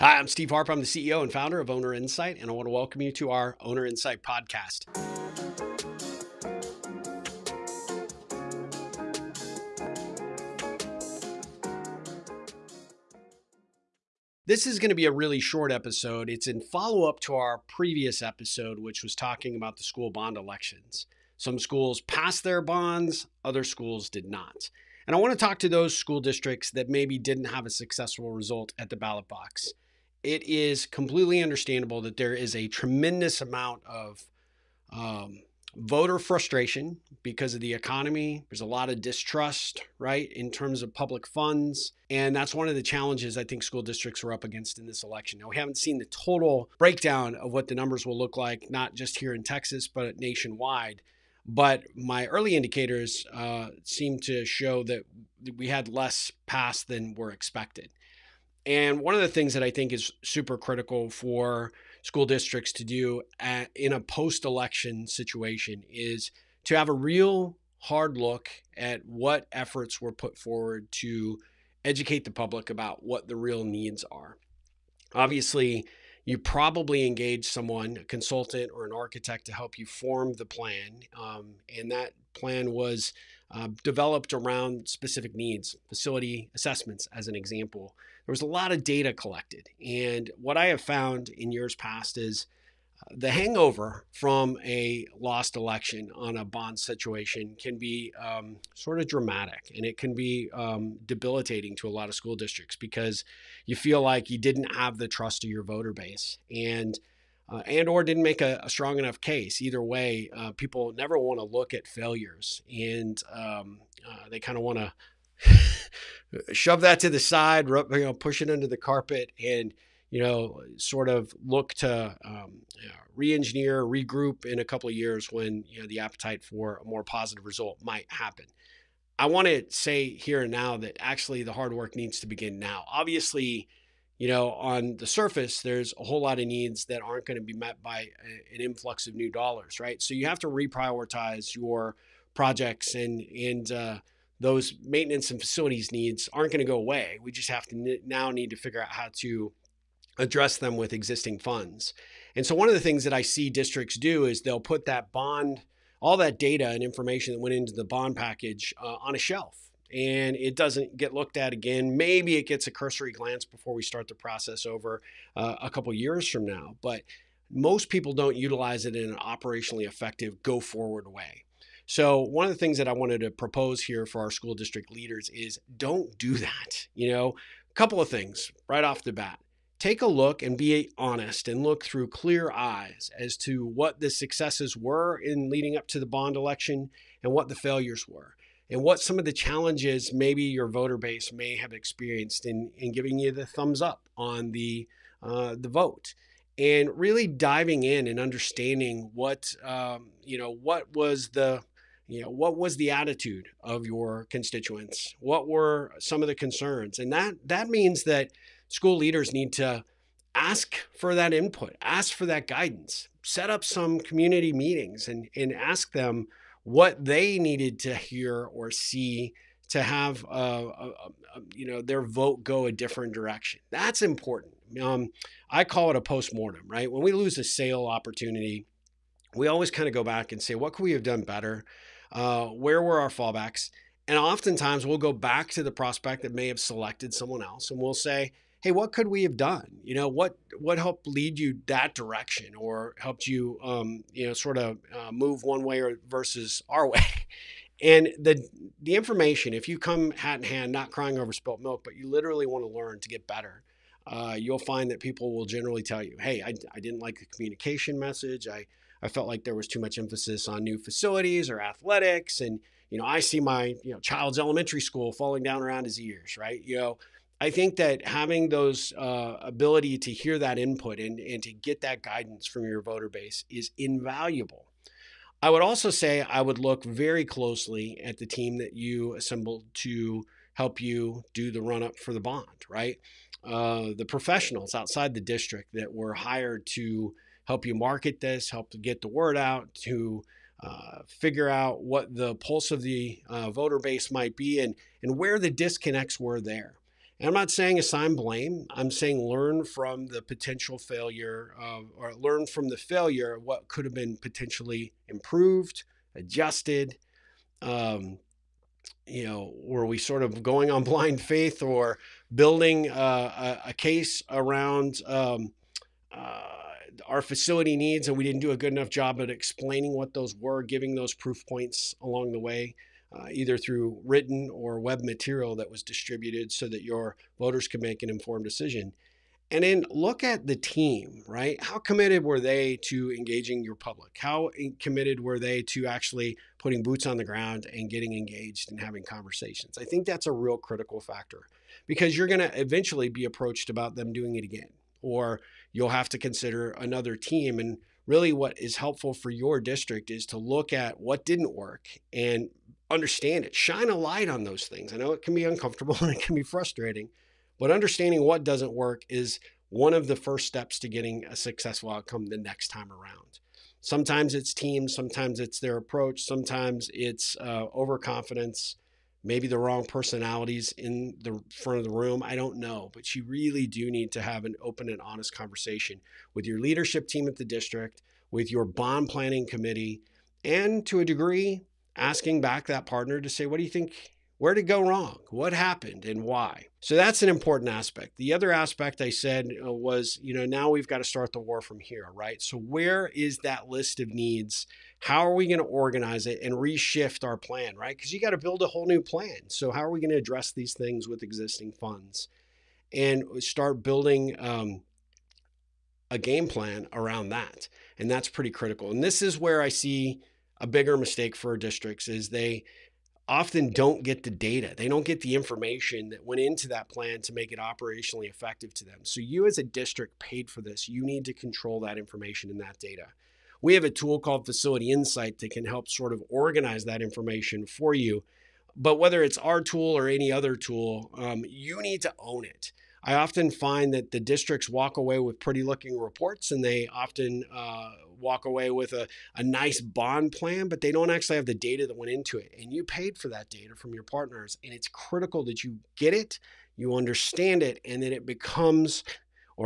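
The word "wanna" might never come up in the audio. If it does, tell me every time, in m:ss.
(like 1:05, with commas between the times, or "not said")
not said.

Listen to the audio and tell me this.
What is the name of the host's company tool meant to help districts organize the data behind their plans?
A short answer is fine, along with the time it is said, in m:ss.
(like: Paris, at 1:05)
Facility Insite, at 7:04.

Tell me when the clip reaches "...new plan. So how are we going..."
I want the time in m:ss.
6:38.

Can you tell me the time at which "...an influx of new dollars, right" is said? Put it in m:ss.
2:18.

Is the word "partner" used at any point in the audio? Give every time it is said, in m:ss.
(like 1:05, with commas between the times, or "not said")
6:22, 7:24.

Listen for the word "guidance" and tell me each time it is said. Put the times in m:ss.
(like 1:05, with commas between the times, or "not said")
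3:32, 4:32.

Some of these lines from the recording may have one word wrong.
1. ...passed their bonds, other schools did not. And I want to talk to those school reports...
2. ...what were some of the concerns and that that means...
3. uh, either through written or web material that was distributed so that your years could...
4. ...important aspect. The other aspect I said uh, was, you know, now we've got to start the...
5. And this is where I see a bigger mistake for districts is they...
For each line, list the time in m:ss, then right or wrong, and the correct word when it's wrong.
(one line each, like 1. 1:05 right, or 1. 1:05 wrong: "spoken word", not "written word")
1. 0:22 wrong: "districts", not "reports"
2. 3:25 right
3. 5:23 wrong: "voters", not "years"
4. 6:27 right
5. 6:48 right.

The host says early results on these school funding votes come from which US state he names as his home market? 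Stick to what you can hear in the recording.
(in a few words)
Texas.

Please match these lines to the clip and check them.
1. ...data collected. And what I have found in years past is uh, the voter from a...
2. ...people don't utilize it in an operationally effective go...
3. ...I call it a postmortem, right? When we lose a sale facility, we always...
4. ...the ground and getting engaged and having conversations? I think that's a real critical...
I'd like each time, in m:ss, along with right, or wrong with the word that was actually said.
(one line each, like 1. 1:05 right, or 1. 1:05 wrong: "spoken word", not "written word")
1. 1:28 wrong: "hangover", not "voter"
2. 2:47 right
3. 3:45 wrong: "opportunity", not "facility"
4. 5:37 right.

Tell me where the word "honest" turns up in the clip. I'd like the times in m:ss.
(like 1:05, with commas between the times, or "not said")
3:00, 6:15.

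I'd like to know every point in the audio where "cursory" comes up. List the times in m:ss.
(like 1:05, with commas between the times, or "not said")
2:42.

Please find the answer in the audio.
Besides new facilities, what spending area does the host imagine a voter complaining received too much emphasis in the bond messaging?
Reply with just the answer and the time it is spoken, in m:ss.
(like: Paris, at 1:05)
athletics, at 4:21.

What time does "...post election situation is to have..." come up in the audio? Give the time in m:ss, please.
1:03.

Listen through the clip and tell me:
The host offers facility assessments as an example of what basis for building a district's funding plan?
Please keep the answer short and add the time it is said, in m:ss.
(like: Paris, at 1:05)
specific needs, at 1:24.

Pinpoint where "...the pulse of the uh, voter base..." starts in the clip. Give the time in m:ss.
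4:52.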